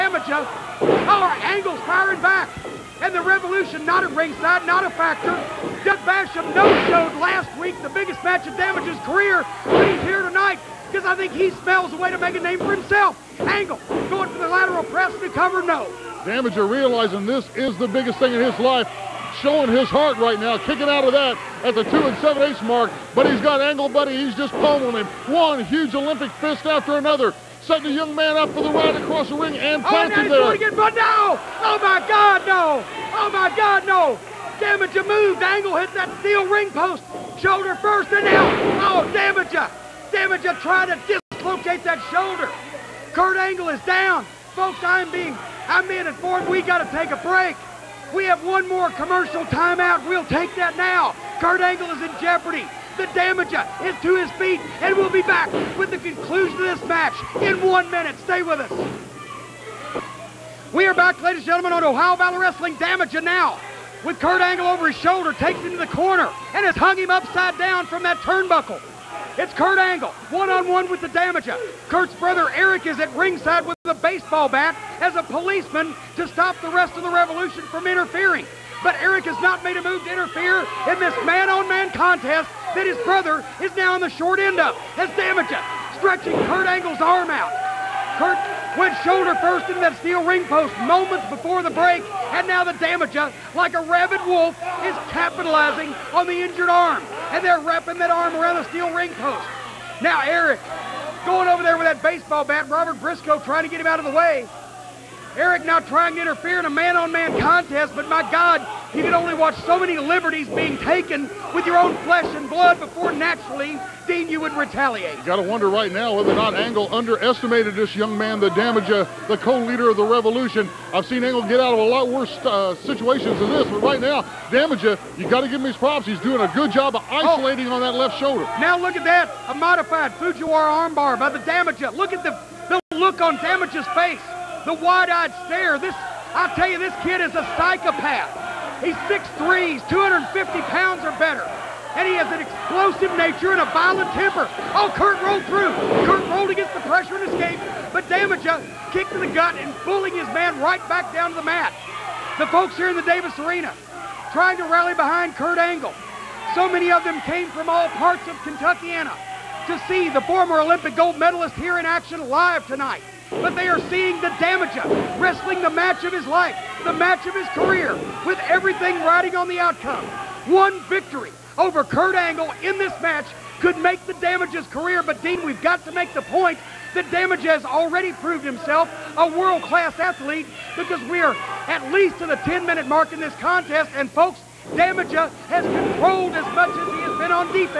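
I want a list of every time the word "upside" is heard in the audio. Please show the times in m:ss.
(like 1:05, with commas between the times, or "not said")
1:07.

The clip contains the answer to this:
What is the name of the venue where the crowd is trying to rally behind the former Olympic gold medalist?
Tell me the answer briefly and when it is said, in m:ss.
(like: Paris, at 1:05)
Davis Arena, at 2:33.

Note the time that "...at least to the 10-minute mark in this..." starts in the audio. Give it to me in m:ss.
3:01.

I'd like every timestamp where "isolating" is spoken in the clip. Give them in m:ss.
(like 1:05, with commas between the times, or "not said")
2:07.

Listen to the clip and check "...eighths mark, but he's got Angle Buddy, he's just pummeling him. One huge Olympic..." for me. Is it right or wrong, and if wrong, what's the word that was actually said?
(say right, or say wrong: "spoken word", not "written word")
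right.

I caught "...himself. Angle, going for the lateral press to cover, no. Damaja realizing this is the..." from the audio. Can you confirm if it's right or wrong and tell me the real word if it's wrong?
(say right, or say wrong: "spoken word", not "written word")
right.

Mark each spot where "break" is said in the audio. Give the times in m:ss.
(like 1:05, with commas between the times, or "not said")
0:47, 1:31.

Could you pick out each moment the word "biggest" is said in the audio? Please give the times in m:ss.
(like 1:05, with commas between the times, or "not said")
0:07, 0:17.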